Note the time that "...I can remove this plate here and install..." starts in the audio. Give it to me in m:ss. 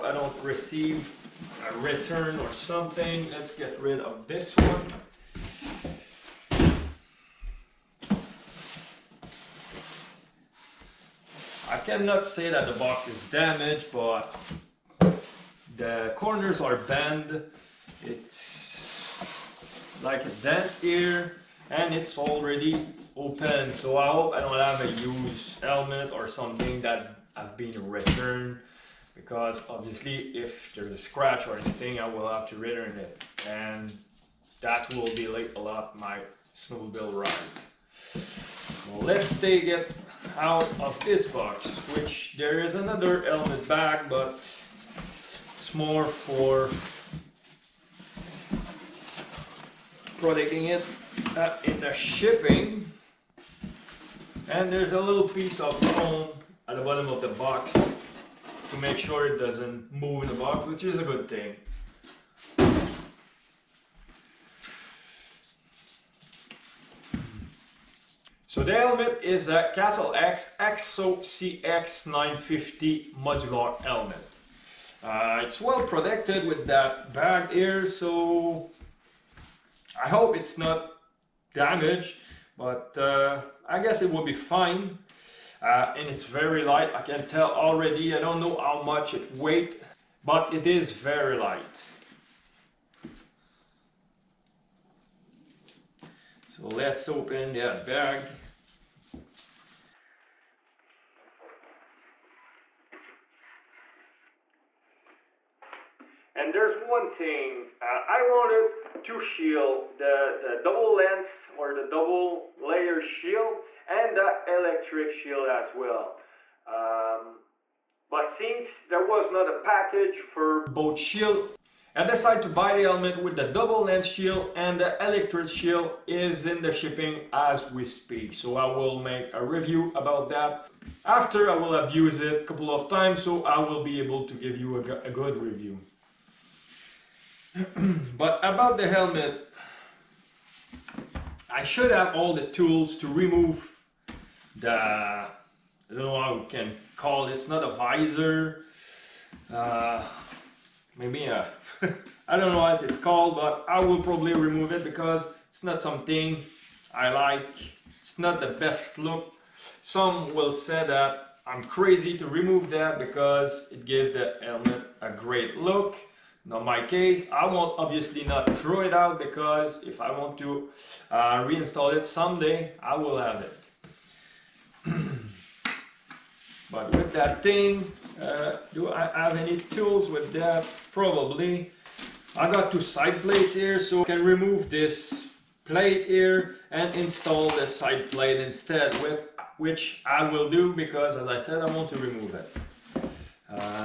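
3:04.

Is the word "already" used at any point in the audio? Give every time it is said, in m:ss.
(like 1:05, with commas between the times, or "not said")
0:22, 1:27.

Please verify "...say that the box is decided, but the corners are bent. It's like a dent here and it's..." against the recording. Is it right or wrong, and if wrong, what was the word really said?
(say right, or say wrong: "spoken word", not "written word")
wrong: "damaged", not "decided".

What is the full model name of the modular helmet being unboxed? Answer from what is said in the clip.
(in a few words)
Castle X EXO CX950.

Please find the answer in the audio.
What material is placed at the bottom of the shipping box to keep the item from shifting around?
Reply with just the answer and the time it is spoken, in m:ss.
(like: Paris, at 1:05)
foam, at 0:55.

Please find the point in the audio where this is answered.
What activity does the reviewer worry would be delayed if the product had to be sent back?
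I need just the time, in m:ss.
0:36.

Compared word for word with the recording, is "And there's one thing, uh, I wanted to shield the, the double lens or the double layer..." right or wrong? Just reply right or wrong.
right.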